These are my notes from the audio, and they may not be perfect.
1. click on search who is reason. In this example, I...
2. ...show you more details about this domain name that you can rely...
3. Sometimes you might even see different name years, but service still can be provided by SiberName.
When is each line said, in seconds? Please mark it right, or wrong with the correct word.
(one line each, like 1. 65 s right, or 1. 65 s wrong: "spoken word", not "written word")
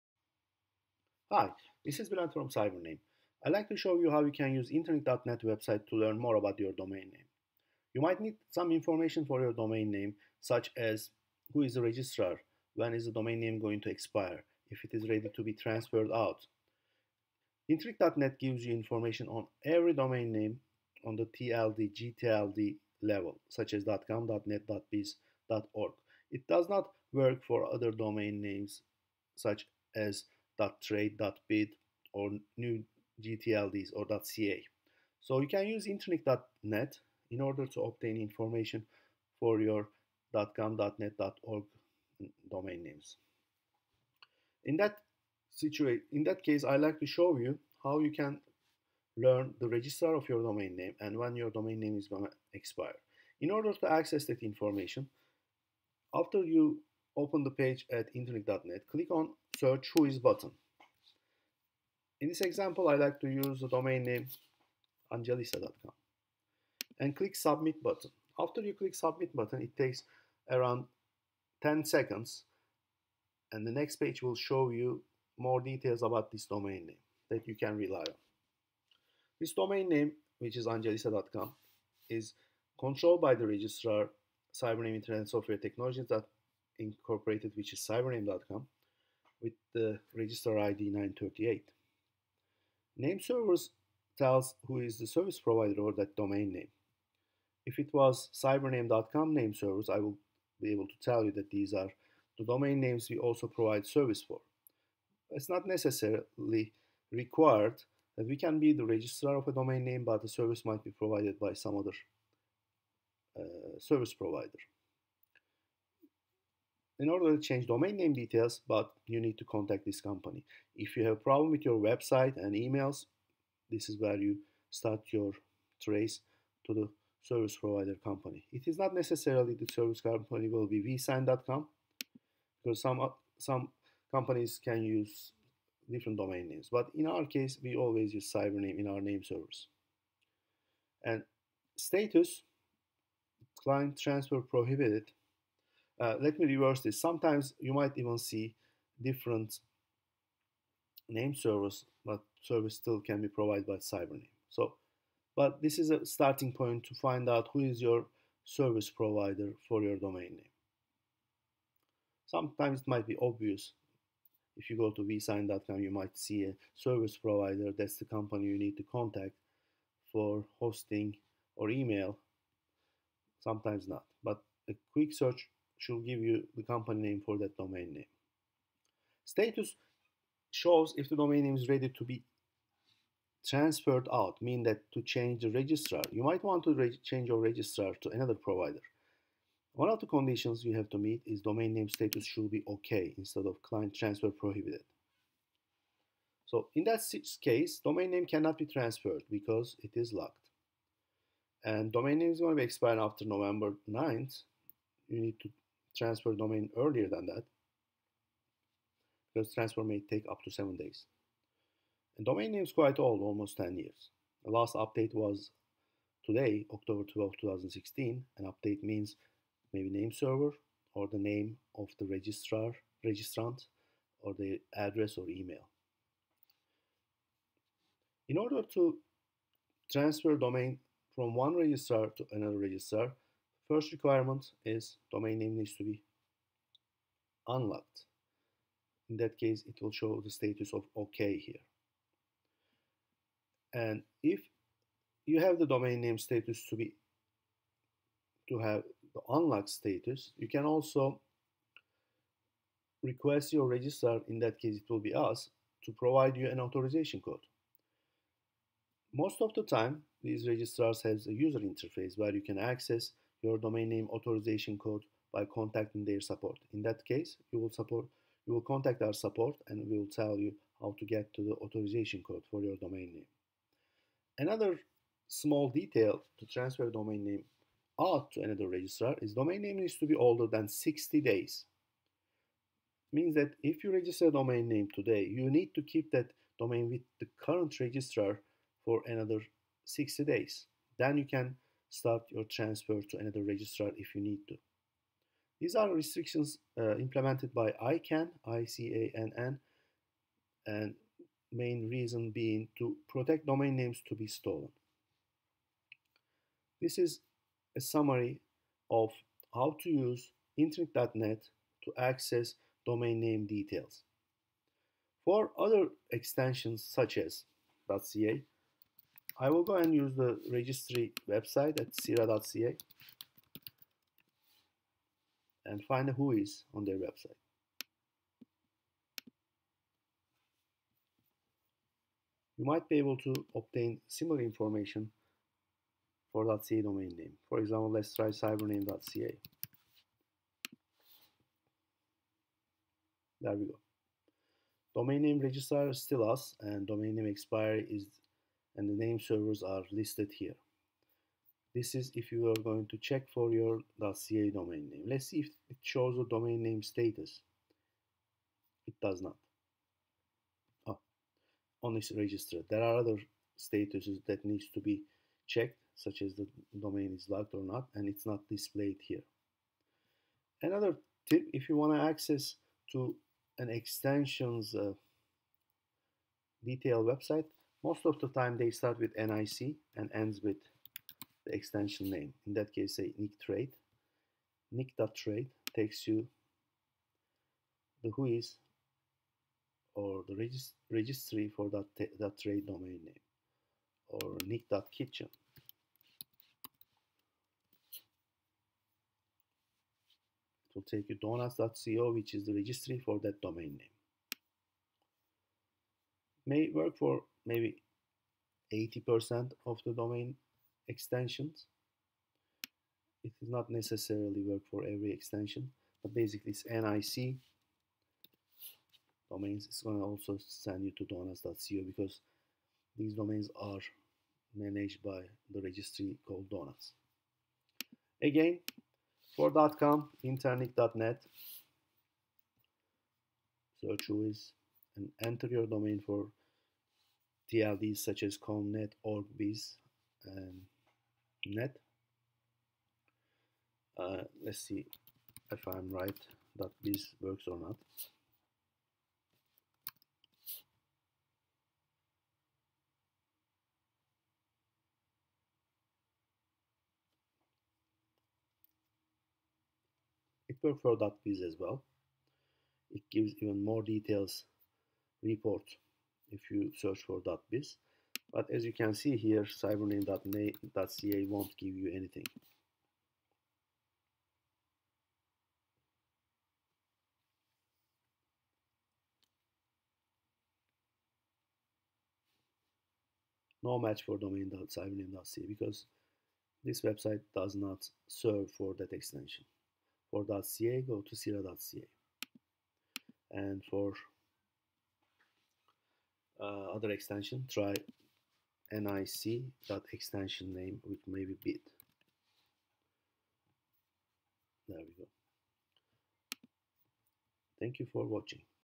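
1. 58 s wrong: "button", not "reason"
2. 74 s right
3. 146 s wrong: "servers", not "years".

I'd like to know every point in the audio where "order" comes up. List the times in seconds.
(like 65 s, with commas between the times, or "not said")
37 s, 53 s, 117 s, 228 s.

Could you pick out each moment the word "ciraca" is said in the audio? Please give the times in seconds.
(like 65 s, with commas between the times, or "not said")
321 s, 491 s.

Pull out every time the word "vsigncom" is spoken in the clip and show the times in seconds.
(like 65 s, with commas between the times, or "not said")
130 s, 165 s.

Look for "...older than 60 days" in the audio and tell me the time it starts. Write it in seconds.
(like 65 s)
280 s.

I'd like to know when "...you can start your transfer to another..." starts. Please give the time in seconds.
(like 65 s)
291 s.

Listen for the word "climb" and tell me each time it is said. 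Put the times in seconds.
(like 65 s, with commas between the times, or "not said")
not said.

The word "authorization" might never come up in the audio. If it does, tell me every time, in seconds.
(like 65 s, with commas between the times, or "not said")
256 s, 264 s, 271 s.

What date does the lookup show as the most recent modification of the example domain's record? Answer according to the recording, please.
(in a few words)
October 12, 2016.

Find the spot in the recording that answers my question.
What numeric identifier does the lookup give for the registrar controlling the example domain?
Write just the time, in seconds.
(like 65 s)
90 s.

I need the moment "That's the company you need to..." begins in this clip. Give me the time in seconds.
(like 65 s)
167 s.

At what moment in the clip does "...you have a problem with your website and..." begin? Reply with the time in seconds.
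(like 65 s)
120 s.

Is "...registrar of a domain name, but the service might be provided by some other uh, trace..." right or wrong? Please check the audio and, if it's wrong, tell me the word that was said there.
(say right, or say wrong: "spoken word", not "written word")
wrong: "service", not "trace".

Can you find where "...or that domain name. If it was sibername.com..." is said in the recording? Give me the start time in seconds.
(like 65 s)
95 s.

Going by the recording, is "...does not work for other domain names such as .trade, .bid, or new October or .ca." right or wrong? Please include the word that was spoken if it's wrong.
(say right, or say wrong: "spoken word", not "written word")
wrong: "GTLDs", not "October".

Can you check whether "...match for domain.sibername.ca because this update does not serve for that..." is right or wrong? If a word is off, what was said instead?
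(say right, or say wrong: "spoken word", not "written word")
wrong: "website", not "update".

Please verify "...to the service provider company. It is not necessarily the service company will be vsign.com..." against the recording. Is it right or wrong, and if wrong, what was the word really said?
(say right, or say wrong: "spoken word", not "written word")
right.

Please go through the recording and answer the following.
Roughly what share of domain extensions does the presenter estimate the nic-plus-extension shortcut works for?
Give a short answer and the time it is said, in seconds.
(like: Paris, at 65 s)
80%, at 408 s.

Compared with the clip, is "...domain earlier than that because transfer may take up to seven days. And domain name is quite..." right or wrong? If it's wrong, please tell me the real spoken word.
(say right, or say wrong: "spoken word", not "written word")
right.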